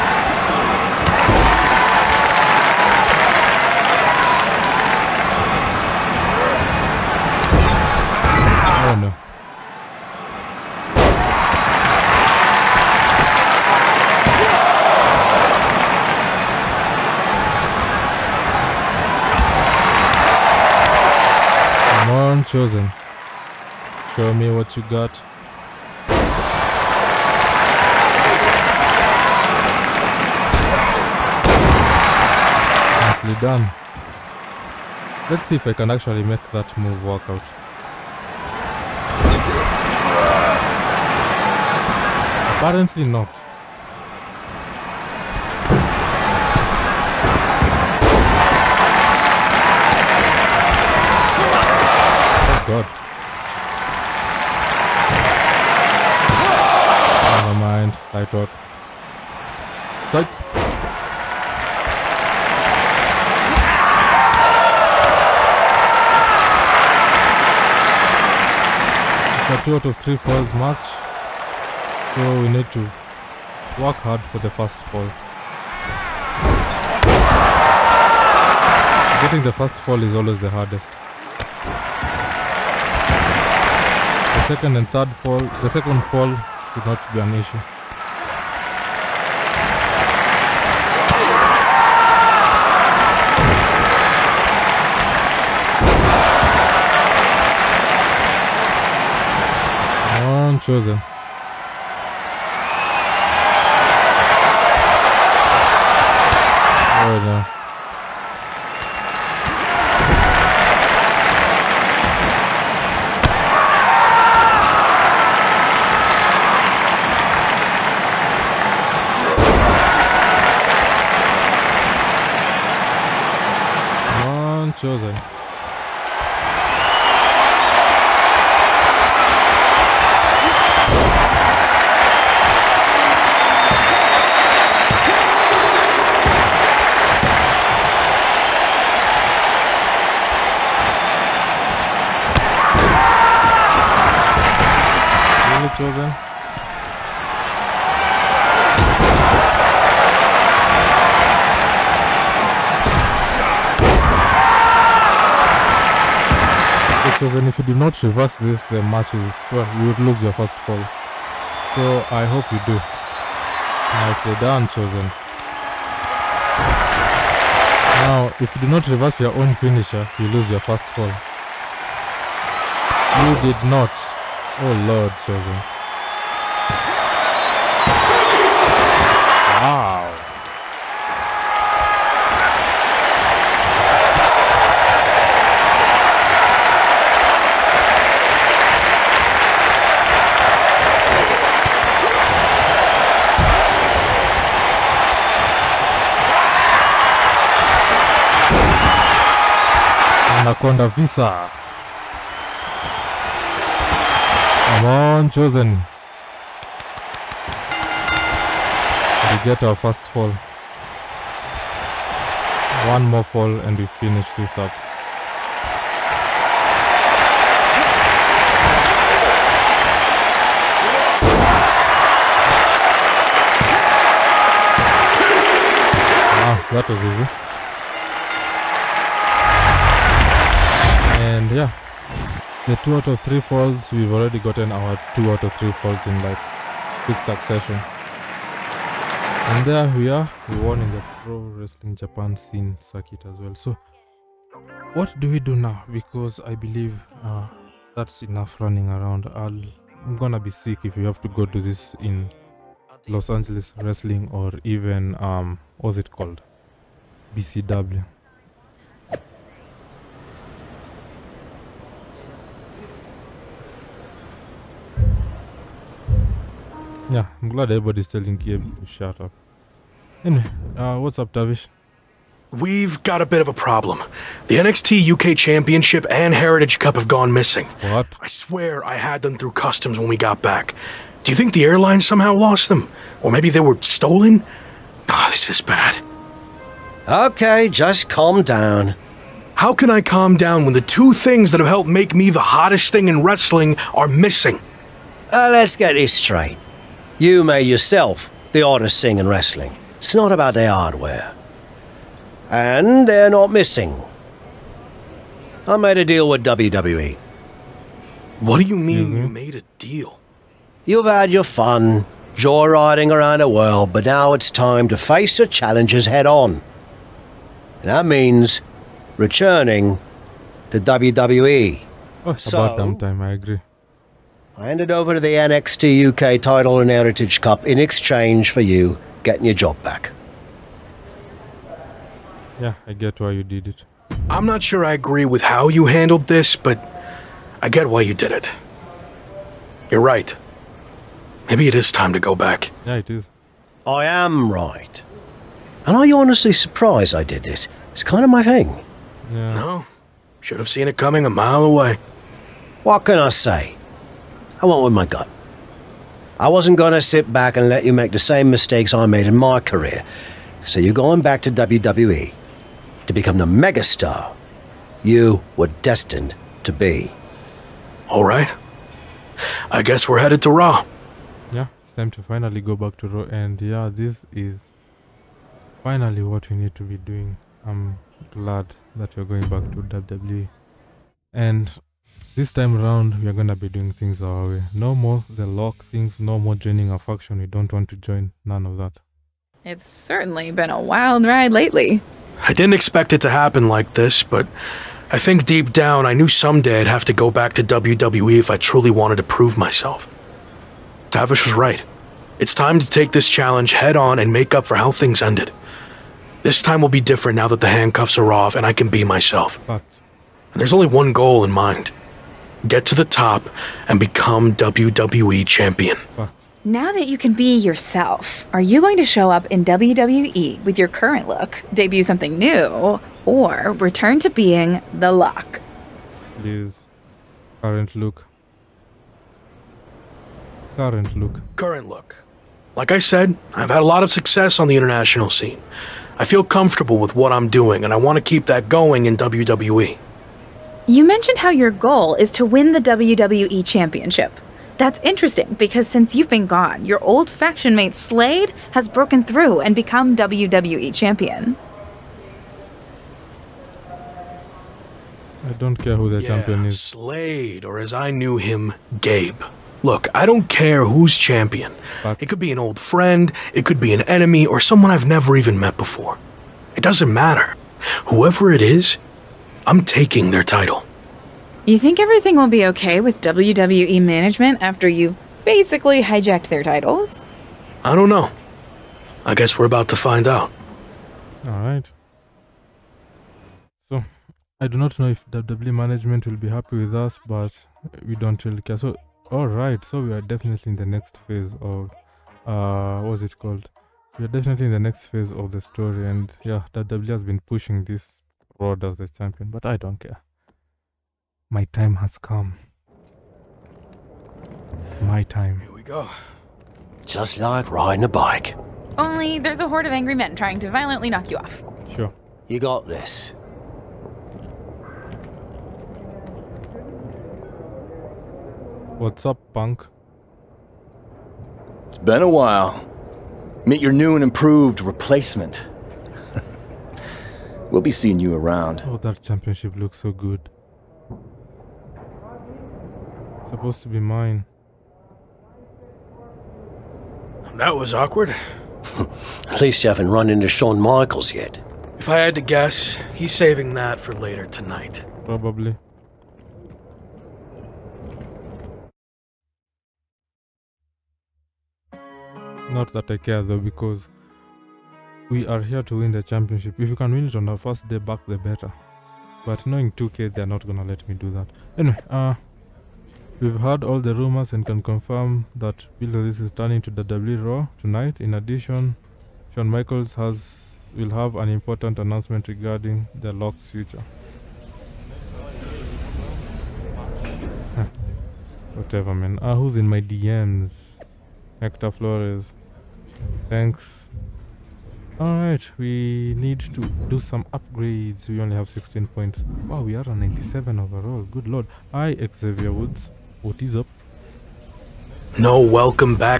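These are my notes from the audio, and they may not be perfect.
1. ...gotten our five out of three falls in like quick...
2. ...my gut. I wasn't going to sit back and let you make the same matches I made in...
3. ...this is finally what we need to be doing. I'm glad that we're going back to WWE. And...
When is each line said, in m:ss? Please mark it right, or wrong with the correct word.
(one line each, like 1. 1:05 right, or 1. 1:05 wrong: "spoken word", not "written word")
1. 3:54 wrong: "two", not "five"
2. 5:54 wrong: "mistakes", not "matches"
3. 6:13 right.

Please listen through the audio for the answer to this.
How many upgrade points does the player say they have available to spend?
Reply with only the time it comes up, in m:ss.
9:48.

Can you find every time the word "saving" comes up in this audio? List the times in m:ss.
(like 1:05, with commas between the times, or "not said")
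9:03.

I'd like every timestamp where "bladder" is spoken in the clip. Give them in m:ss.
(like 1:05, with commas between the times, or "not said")
not said.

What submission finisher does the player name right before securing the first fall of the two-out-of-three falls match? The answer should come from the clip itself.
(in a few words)
Anaconda Vise.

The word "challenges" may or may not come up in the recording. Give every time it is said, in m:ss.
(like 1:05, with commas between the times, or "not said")
5:15, 6:43.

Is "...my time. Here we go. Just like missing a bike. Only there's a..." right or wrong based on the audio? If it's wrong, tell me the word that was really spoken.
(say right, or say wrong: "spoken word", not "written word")
wrong: "riding", not "missing".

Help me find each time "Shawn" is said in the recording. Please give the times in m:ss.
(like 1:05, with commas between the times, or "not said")
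9:00, 9:29.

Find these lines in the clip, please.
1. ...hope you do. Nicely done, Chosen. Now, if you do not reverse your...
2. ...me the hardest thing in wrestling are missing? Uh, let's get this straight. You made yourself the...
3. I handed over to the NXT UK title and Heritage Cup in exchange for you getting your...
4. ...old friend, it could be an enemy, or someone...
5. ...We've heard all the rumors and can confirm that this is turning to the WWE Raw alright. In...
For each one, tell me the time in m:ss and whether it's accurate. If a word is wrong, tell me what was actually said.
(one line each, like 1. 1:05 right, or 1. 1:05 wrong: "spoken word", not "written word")
1. 2:42 right
2. 4:52 wrong: "hottest", not "hardest"
3. 5:24 right
4. 7:42 right
5. 9:23 wrong: "tonight", not "alright".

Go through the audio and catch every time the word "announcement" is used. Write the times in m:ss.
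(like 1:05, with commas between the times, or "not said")
9:31.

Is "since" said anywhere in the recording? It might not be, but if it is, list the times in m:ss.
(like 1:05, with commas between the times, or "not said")
7:25.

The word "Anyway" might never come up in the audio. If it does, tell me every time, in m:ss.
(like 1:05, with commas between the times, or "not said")
4:30, 9:21.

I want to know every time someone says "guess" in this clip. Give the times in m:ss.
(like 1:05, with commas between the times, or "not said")
6:09, 7:59, 9:02.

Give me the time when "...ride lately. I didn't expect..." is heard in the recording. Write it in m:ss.
6:31.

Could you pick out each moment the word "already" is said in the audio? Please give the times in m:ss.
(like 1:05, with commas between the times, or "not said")
3:54.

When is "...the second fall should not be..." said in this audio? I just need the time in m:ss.
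1:25.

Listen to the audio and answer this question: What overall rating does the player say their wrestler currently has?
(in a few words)
97.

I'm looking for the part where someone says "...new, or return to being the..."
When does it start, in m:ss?
7:02.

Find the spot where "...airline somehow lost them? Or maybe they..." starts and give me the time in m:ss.
4:41.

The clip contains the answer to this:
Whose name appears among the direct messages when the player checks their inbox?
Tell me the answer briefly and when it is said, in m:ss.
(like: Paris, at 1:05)
Hector Flores, at 9:41.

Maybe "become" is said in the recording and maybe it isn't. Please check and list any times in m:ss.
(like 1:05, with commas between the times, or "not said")
6:03, 6:53, 7:29.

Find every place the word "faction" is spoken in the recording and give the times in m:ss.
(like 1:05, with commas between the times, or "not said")
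6:26, 7:27.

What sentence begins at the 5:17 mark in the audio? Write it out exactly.
And that means returning to WWE.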